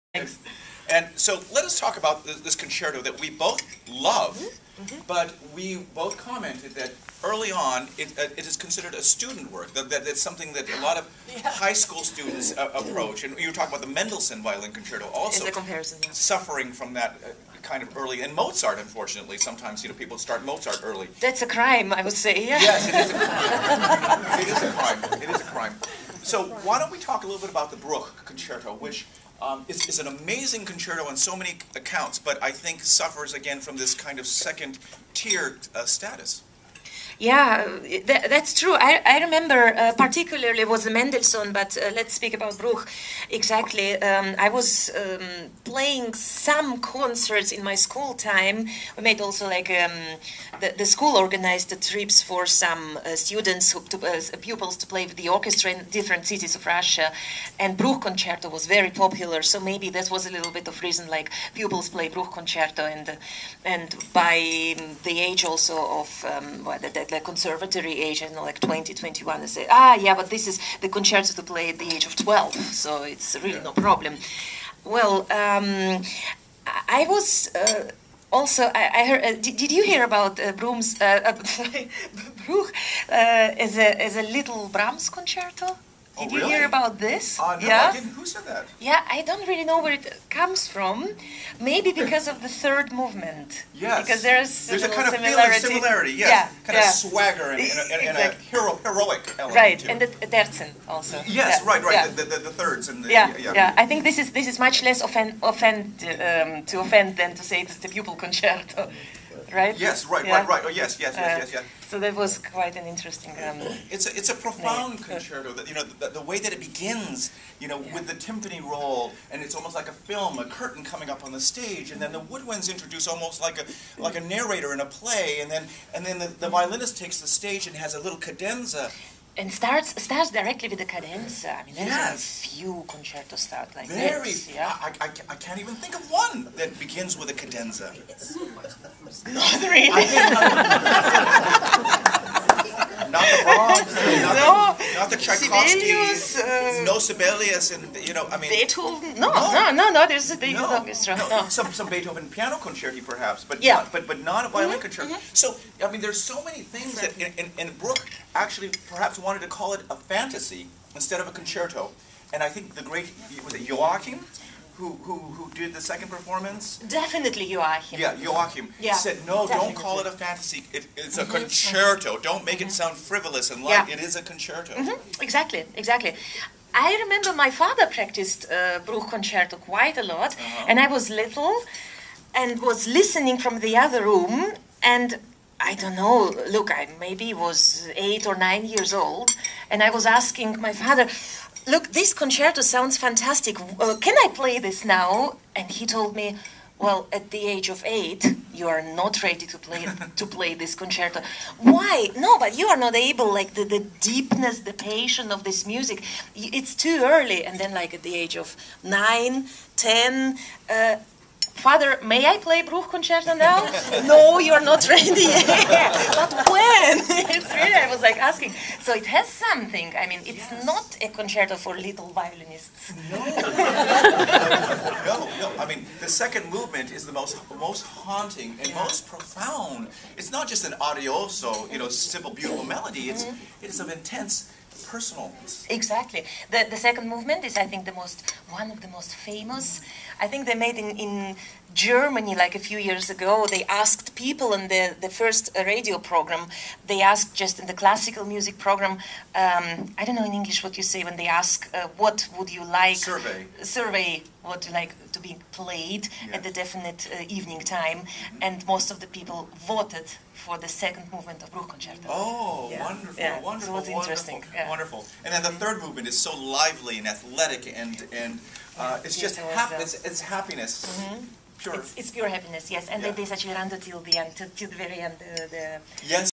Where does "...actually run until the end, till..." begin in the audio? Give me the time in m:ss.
4:33.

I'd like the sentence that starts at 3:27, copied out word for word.
And then, like at the age of nine, ten, uh, father, may I play Bruch concerto now?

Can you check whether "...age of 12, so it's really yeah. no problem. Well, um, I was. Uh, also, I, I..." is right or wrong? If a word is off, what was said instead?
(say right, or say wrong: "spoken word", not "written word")
right.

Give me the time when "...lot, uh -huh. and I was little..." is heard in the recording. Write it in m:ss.
3:00.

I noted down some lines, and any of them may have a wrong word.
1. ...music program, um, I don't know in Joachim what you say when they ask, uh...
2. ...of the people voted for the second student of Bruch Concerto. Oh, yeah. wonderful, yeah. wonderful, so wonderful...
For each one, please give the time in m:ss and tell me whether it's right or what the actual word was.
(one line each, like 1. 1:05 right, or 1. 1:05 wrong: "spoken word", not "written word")
1. 4:08 wrong: "English", not "Joachim"
2. 4:18 wrong: "movement", not "student".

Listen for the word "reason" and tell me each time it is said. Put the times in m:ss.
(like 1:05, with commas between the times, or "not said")
1:00.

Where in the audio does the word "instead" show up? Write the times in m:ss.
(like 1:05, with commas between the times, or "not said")
2:40.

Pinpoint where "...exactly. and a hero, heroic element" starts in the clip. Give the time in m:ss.
1:38.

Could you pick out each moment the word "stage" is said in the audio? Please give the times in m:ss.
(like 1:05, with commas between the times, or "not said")
2:01, 2:07.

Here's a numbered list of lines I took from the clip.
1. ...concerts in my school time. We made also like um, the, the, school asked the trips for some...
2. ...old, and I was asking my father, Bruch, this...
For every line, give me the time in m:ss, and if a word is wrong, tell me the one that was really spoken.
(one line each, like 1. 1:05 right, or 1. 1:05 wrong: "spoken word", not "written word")
1. 0:46 wrong: "organized", not "asked"
2. 3:09 wrong: "Look", not "Bruch".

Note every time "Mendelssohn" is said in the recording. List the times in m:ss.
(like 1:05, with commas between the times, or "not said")
0:13, 0:40.